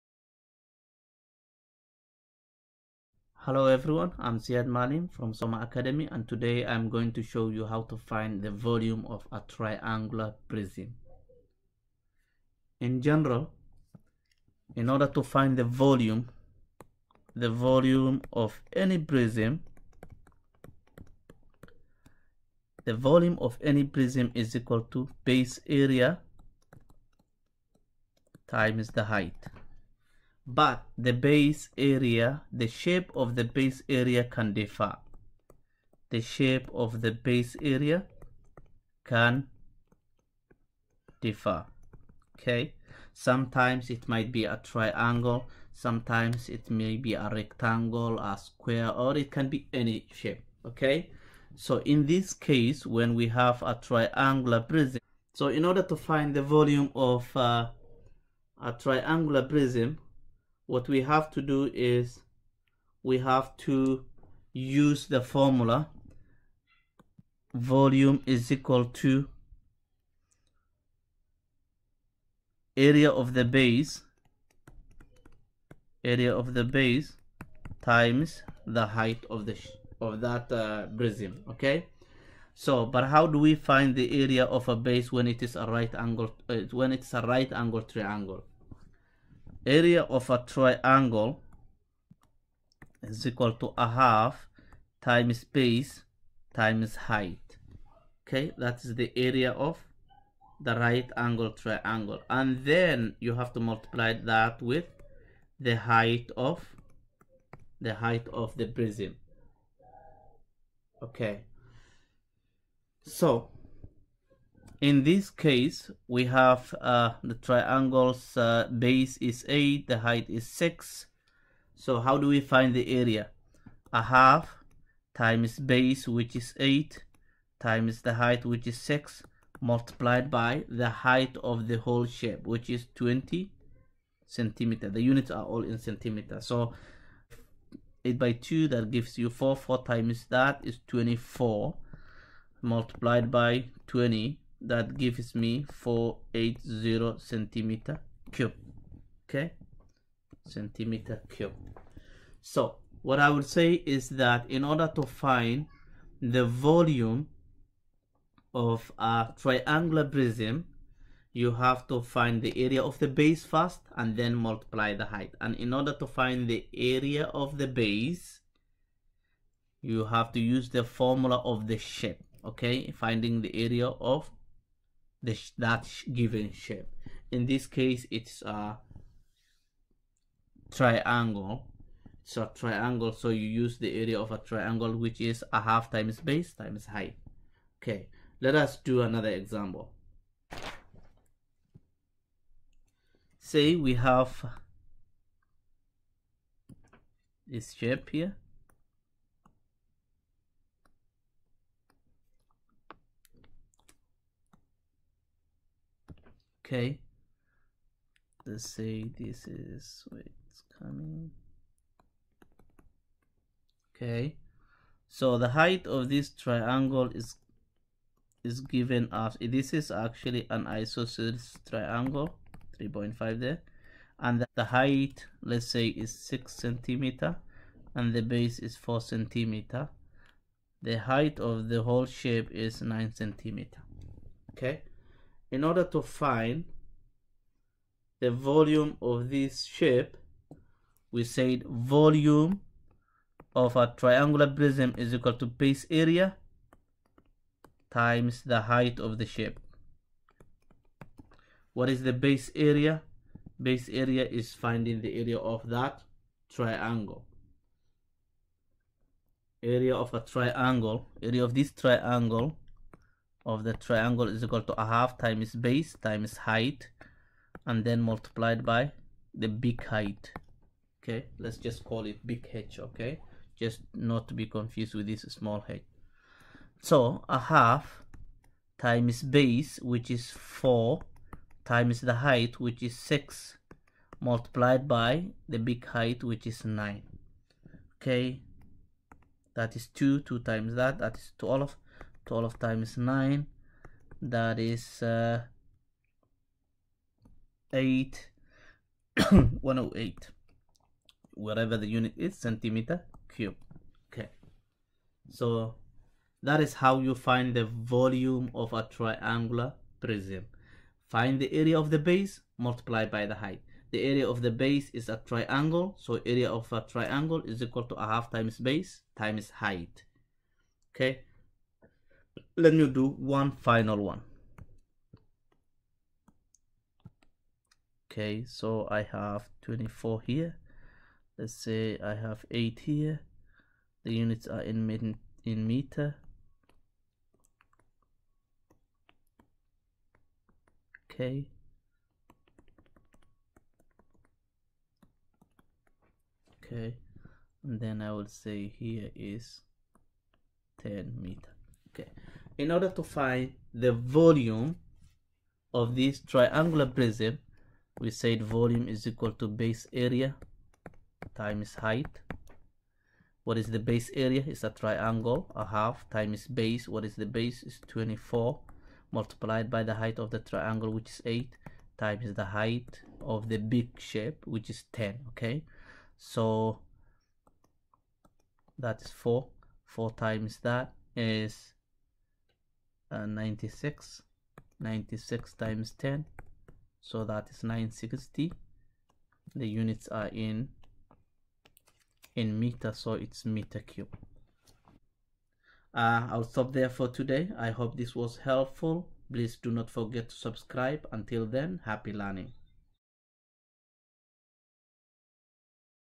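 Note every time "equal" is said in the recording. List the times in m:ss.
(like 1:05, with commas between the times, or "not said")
0:24, 1:08, 1:33, 4:05, 4:24, 5:17, 5:59.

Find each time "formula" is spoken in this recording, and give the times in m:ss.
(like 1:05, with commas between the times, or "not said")
1:05, 2:50.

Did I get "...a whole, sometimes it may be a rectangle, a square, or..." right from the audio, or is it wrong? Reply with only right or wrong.
wrong.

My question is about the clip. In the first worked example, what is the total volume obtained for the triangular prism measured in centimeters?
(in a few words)
480 cubic centimeters.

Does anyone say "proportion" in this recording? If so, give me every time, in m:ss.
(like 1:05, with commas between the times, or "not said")
not said.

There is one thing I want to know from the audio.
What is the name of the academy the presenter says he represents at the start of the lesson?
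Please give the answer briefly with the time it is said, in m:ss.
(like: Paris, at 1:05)
Soma Academy, at 0:05.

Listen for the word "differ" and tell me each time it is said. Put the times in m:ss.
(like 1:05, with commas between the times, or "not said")
0:34, 0:41.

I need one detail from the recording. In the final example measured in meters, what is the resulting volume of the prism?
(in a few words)
960 cubic meters.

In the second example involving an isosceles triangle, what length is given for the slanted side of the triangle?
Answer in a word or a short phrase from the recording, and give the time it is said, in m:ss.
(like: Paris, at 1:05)
3.5, at 3:42.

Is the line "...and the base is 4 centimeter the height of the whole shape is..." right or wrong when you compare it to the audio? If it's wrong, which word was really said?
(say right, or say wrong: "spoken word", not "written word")
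right.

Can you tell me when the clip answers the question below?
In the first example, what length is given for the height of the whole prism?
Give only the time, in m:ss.
2:12.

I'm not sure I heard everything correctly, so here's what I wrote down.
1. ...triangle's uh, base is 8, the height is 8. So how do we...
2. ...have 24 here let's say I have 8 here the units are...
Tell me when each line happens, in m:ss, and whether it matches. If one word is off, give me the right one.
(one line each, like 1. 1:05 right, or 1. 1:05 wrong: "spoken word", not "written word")
1. 1:57 wrong: "6", not "8"
2. 5:29 right.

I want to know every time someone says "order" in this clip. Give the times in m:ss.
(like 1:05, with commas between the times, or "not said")
0:14, 0:55, 2:34, 2:45, 3:55, 5:52.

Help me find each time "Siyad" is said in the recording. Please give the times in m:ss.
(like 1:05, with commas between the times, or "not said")
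0:04.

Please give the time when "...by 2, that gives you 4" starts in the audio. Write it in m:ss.
2:18.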